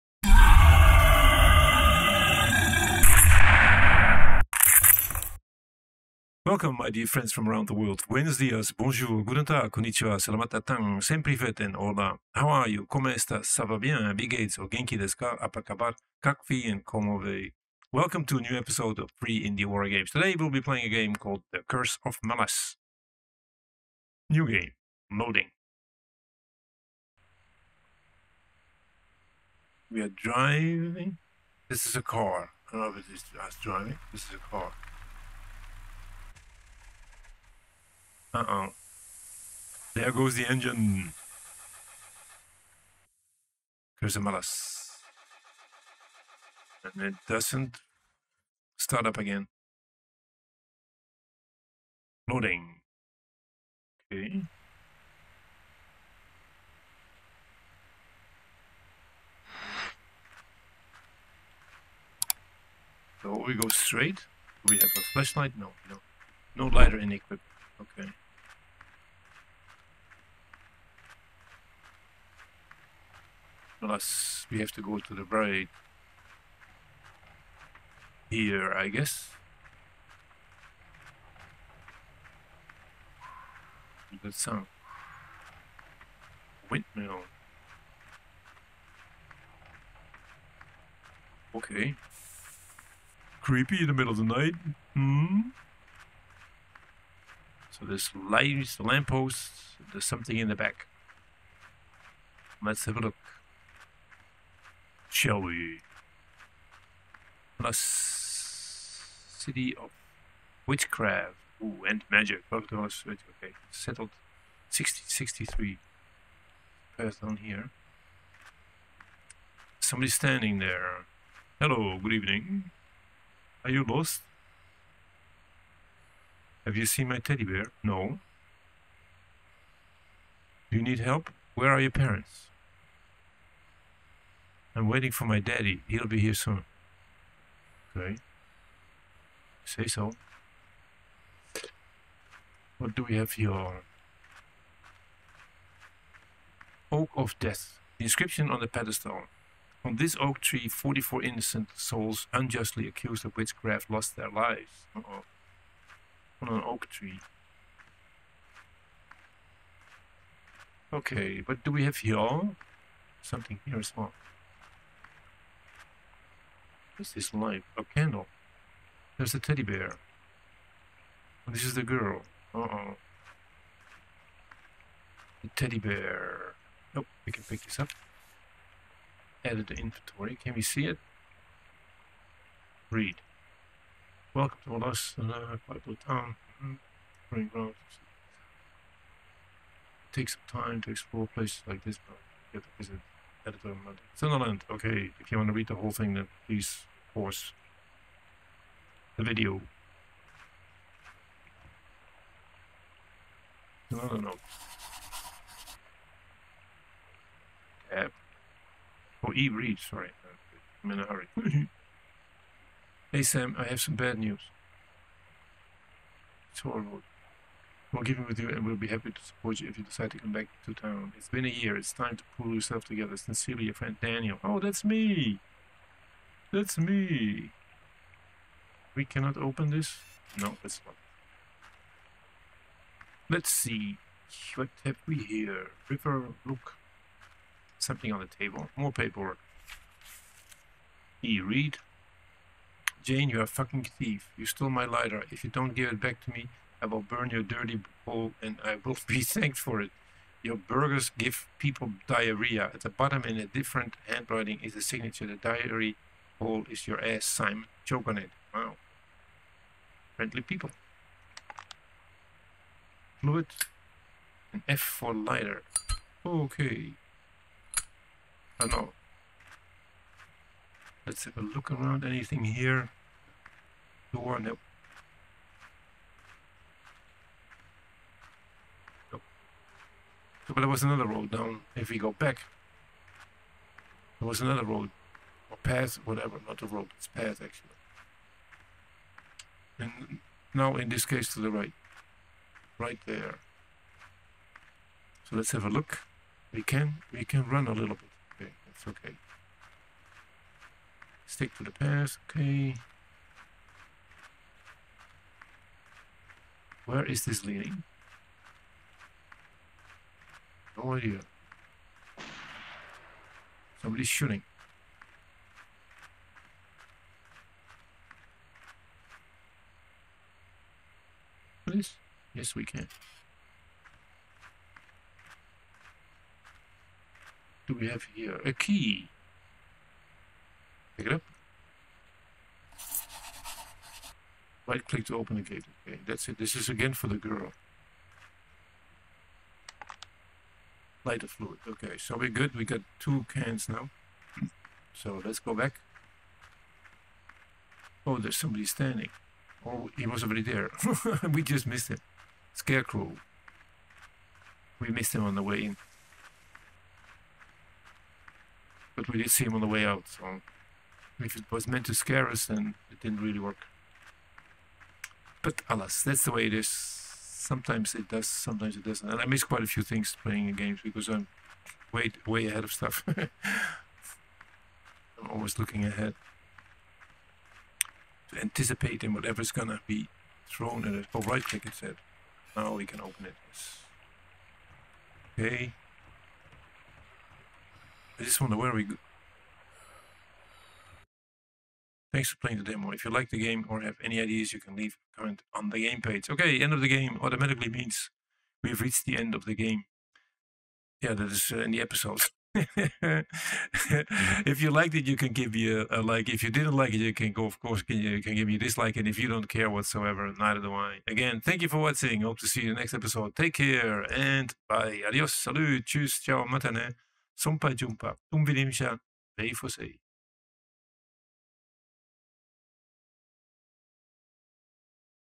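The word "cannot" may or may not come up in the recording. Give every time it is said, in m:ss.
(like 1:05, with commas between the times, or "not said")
3:49.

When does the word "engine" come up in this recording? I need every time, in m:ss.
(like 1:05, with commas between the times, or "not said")
0:40.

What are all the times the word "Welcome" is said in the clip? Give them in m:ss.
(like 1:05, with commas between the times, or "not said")
0:06, 0:17, 3:04.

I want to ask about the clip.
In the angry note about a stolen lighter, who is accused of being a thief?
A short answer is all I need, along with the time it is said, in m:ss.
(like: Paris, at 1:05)
Jane, at 4:03.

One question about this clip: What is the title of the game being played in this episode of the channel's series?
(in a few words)
The Curse of Melas.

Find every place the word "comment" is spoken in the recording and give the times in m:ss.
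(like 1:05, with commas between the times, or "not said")
6:35.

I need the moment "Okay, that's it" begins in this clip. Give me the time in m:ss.
5:35.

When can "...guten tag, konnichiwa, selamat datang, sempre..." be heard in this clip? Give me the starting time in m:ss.
0:09.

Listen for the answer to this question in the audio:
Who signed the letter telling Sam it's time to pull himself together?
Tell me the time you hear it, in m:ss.
3:44.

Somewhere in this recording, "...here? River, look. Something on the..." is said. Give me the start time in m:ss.
3:55.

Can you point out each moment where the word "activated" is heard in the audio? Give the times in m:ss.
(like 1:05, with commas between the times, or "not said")
not said.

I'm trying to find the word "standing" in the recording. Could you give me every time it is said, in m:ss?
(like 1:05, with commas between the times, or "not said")
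2:00, 5:48.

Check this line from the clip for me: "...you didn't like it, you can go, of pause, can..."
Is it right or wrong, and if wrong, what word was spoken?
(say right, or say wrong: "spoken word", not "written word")
wrong: "course", not "pause".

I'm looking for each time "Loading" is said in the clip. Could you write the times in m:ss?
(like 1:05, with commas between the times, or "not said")
0:25, 0:52.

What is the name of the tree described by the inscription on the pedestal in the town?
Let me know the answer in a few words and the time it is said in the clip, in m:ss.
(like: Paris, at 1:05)
Oak of Death, at 2:26.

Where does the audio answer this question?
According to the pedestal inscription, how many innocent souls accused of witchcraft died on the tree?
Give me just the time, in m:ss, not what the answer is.
2:30.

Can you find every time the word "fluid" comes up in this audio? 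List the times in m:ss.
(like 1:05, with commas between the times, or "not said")
4:23, 5:41.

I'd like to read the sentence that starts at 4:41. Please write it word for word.
If we go back, there was another road.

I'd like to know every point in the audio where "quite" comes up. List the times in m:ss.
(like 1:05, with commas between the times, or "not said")
6:09.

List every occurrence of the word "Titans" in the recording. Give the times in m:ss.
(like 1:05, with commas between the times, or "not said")
not said.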